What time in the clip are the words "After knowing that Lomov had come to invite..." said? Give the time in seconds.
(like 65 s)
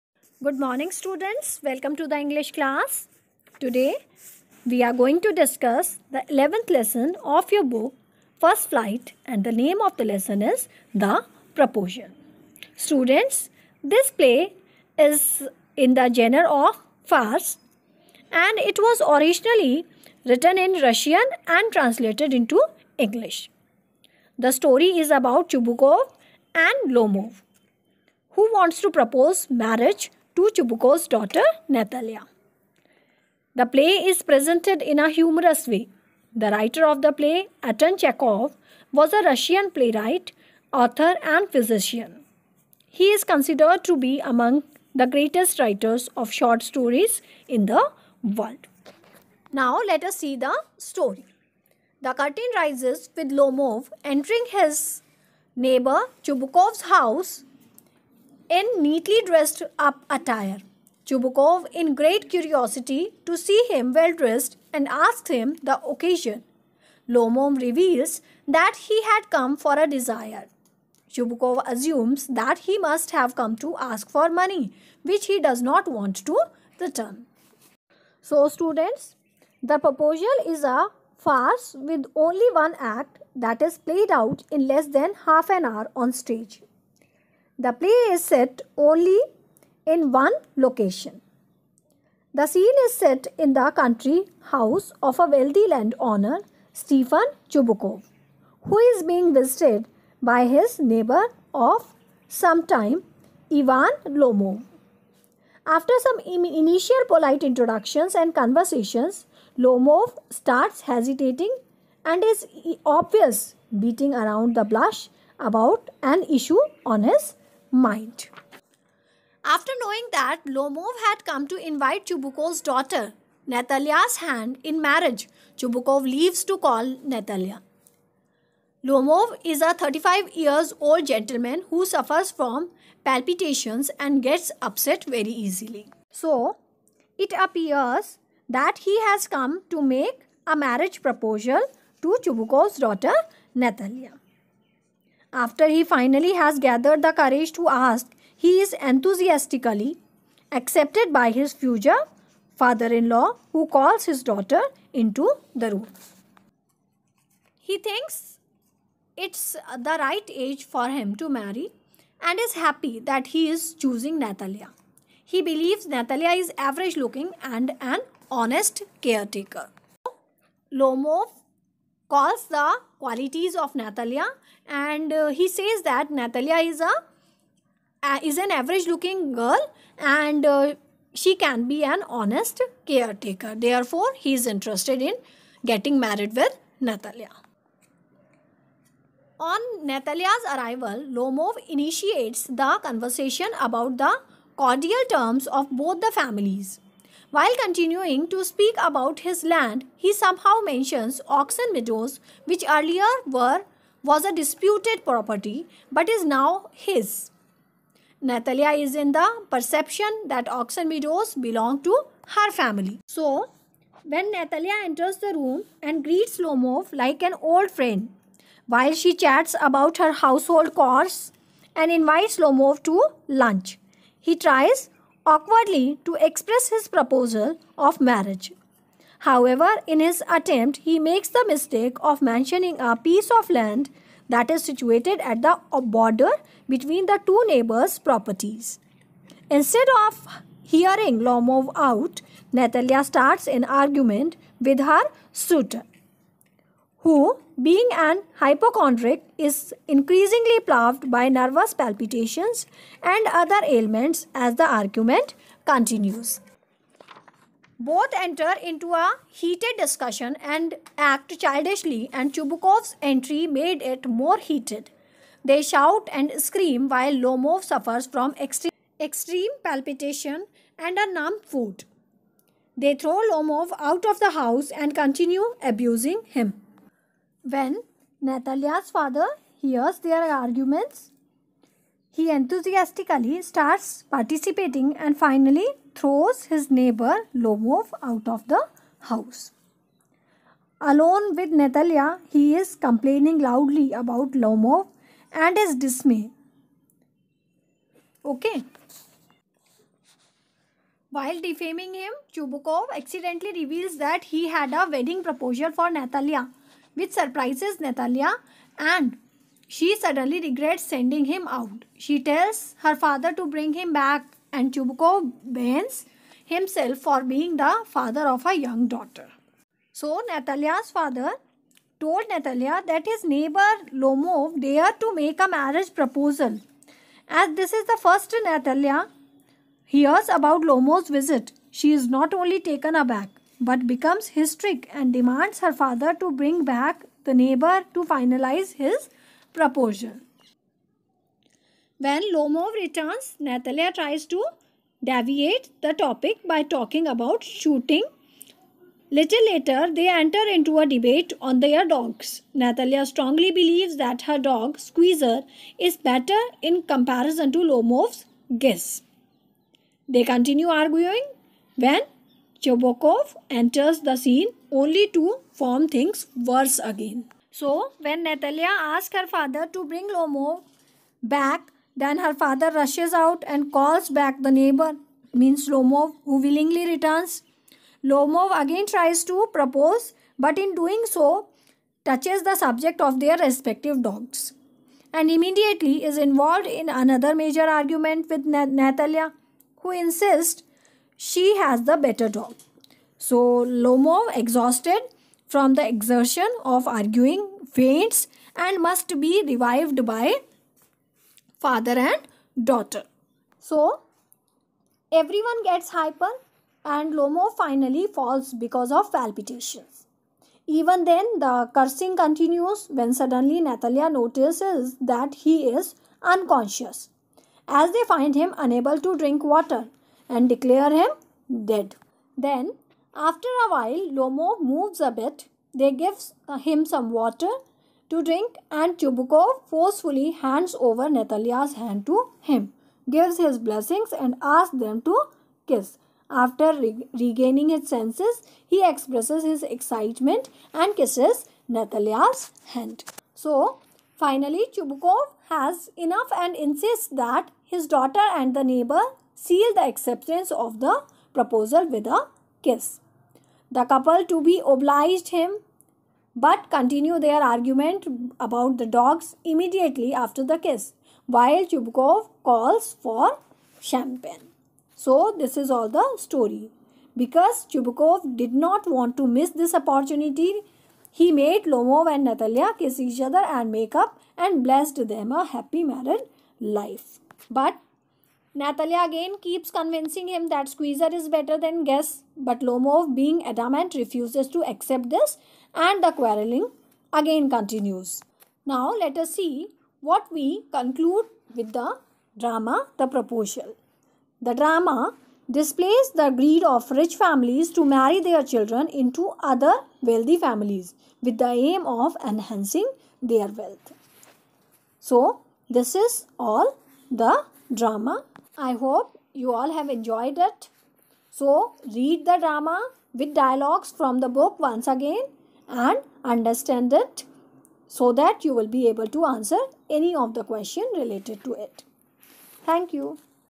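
119 s.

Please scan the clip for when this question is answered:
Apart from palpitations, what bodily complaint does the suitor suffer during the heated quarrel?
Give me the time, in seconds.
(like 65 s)
271 s.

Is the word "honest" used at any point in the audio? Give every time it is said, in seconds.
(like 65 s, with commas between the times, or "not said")
168 s, 182 s.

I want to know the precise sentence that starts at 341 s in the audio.
When Lomov returns, Natalia tries to deviate the topic by talking about shooting.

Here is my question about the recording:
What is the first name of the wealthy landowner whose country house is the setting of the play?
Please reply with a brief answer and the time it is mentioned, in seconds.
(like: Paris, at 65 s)
Stefan, at 96 s.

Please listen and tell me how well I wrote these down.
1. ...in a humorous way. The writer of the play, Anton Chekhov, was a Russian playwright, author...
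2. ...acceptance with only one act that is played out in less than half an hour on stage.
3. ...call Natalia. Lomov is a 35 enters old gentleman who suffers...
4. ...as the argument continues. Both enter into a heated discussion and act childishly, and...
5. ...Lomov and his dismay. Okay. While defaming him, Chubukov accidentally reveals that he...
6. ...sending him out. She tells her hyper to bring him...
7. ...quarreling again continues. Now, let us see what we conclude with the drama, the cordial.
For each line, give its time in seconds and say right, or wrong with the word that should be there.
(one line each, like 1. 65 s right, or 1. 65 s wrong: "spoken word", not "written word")
1. 34 s right
2. 81 s wrong: "farce", not "acceptance"
3. 126 s wrong: "years", not "enters"
4. 254 s right
5. 294 s right
6. 310 s wrong: "father", not "hyper"
7. 486 s wrong: "proposal", not "cordial".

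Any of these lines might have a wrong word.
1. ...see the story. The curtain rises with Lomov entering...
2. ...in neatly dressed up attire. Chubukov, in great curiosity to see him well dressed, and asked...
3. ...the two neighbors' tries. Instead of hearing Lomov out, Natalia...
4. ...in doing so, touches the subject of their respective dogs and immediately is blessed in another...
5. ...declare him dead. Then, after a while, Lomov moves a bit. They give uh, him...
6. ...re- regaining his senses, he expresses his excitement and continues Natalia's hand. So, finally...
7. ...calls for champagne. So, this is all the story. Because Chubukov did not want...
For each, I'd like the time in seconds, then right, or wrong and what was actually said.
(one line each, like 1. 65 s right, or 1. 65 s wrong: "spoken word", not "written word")
1. 50 s right
2. 58 s right
3. 237 s wrong: "properties", not "tries"
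4. 380 s wrong: "involved", not "blessed"
5. 420 s right
6. 436 s wrong: "kisses", not "continues"
7. 462 s right.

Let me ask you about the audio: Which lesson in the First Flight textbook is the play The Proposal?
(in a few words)
11th.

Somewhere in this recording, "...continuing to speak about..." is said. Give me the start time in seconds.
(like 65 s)
197 s.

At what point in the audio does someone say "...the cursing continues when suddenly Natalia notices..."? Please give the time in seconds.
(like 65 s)
411 s.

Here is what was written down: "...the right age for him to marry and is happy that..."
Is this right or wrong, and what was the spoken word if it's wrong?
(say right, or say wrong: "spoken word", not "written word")
right.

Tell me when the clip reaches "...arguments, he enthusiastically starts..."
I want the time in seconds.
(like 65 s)
280 s.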